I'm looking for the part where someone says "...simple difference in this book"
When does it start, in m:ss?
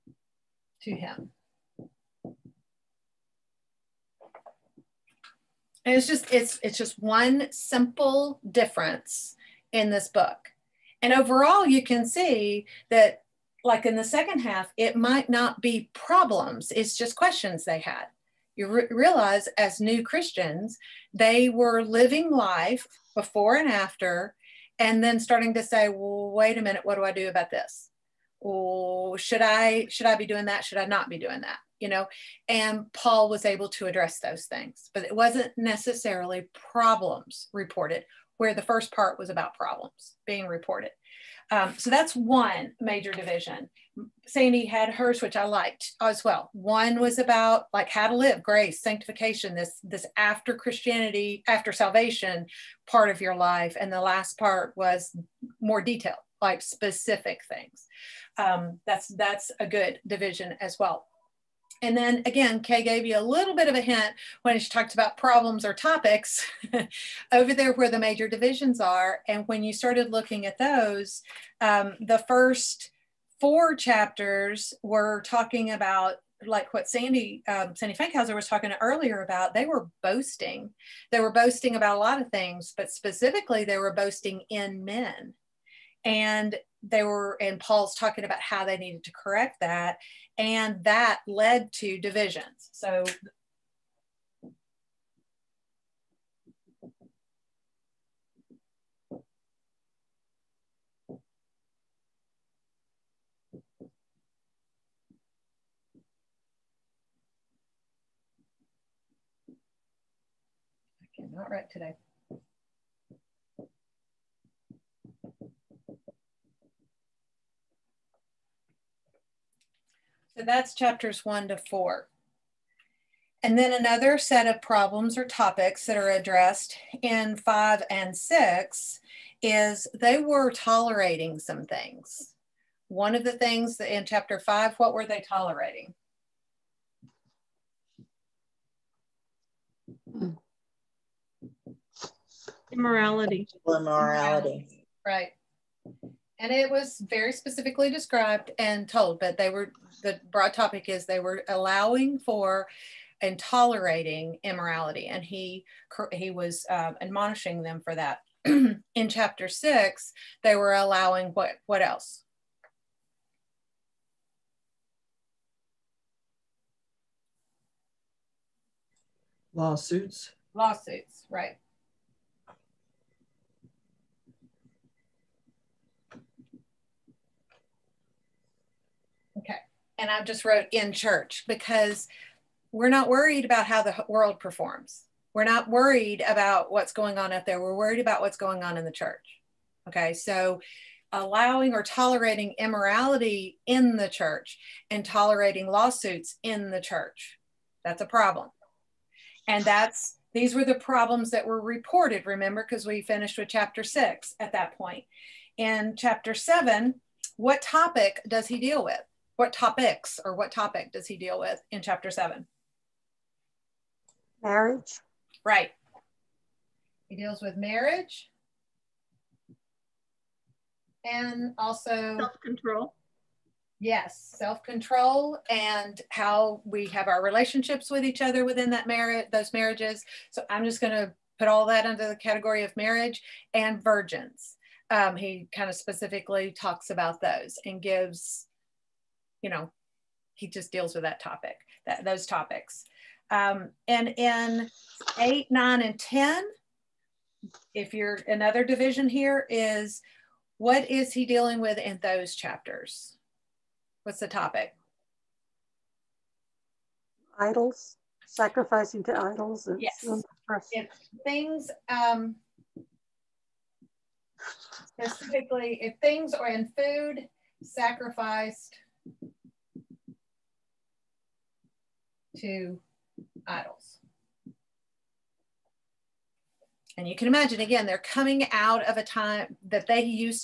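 0:07.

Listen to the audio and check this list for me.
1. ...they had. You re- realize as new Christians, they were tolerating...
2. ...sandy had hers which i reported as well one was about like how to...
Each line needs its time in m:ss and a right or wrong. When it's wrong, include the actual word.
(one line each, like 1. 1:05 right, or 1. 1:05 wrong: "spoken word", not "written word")
1. 0:17 wrong: "living", not "tolerating"
2. 0:44 wrong: "liked", not "reported".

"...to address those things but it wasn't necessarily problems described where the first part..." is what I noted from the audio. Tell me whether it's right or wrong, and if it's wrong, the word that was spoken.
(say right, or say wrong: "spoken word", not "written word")
wrong: "reported", not "described".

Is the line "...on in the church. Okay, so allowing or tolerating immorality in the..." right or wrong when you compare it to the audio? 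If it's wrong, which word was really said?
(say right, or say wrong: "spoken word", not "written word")
right.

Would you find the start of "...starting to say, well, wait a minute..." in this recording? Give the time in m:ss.
0:25.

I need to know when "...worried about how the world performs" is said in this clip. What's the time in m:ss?
3:03.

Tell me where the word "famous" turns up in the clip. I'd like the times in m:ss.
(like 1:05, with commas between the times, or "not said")
not said.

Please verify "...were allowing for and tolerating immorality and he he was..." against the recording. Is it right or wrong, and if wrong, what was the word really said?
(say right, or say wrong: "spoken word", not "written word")
right.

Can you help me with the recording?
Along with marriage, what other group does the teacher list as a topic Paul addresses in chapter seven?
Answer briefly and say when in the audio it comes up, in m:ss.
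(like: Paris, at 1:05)
Virgins, at 3:53.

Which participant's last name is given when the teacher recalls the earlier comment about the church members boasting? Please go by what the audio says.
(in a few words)
Fankhauser.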